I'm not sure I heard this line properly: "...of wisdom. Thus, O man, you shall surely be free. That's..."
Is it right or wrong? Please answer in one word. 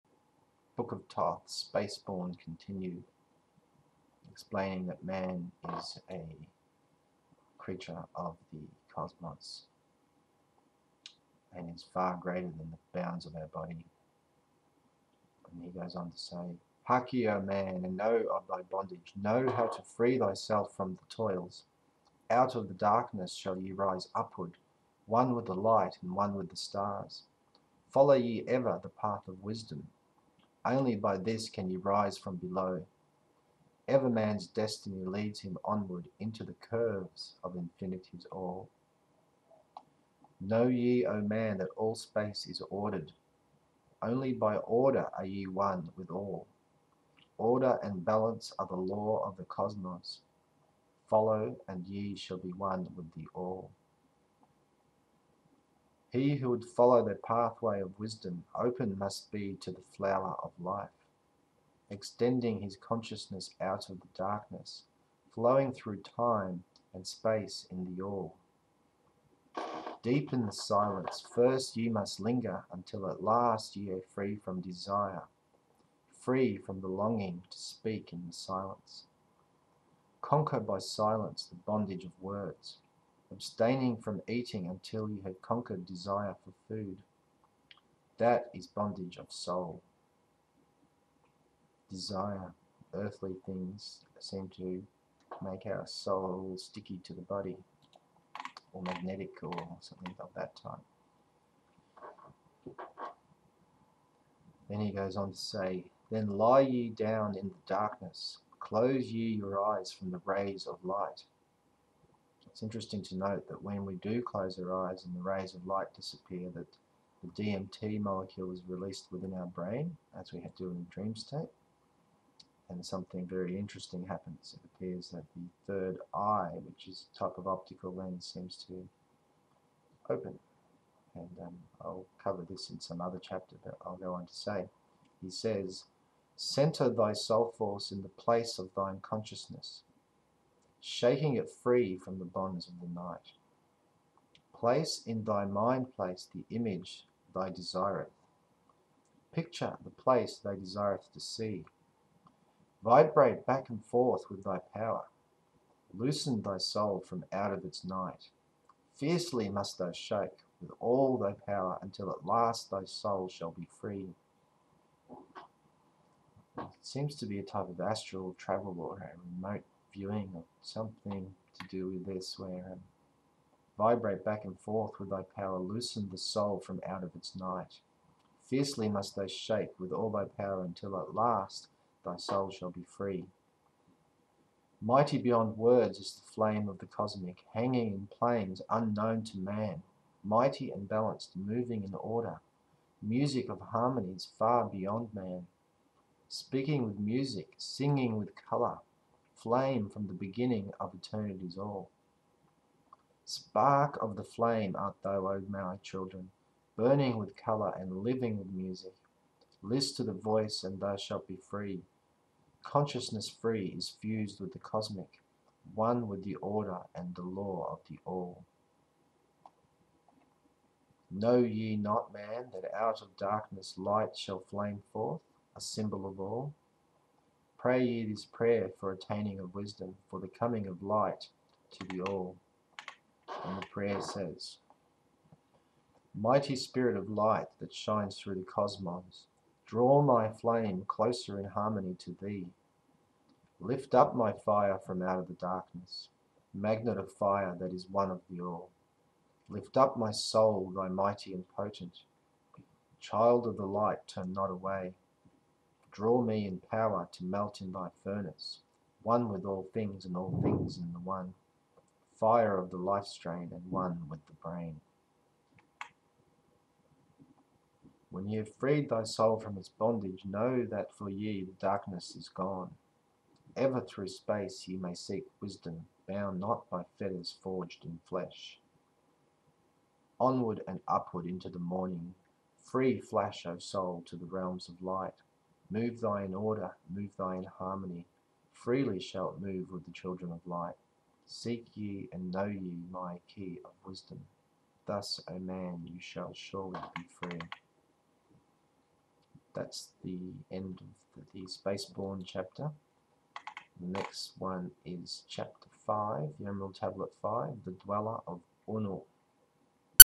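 right.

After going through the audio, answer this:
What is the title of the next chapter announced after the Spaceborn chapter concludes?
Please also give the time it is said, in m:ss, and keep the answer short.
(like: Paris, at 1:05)
The Dweller of Unuk, at 5:07.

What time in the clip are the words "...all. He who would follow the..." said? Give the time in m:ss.
0:53.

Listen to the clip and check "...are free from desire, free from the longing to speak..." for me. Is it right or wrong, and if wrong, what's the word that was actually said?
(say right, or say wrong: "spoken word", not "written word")
right.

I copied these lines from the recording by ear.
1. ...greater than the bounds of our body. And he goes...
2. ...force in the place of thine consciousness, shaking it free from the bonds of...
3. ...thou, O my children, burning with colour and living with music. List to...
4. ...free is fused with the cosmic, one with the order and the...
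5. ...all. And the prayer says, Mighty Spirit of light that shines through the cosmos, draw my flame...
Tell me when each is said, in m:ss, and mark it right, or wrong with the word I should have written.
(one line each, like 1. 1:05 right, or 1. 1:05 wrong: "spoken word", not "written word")
1. 0:12 right
2. 2:17 right
3. 3:25 right
4. 3:33 right
5. 3:52 right.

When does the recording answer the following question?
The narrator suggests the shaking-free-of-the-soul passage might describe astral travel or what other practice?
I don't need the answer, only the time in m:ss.
2:49.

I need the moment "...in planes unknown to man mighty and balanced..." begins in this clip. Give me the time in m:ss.
3:07.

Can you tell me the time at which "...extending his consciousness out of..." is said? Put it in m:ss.
1:01.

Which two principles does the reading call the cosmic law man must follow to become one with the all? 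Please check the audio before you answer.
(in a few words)
Order and balance.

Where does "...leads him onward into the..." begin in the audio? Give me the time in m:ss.
0:35.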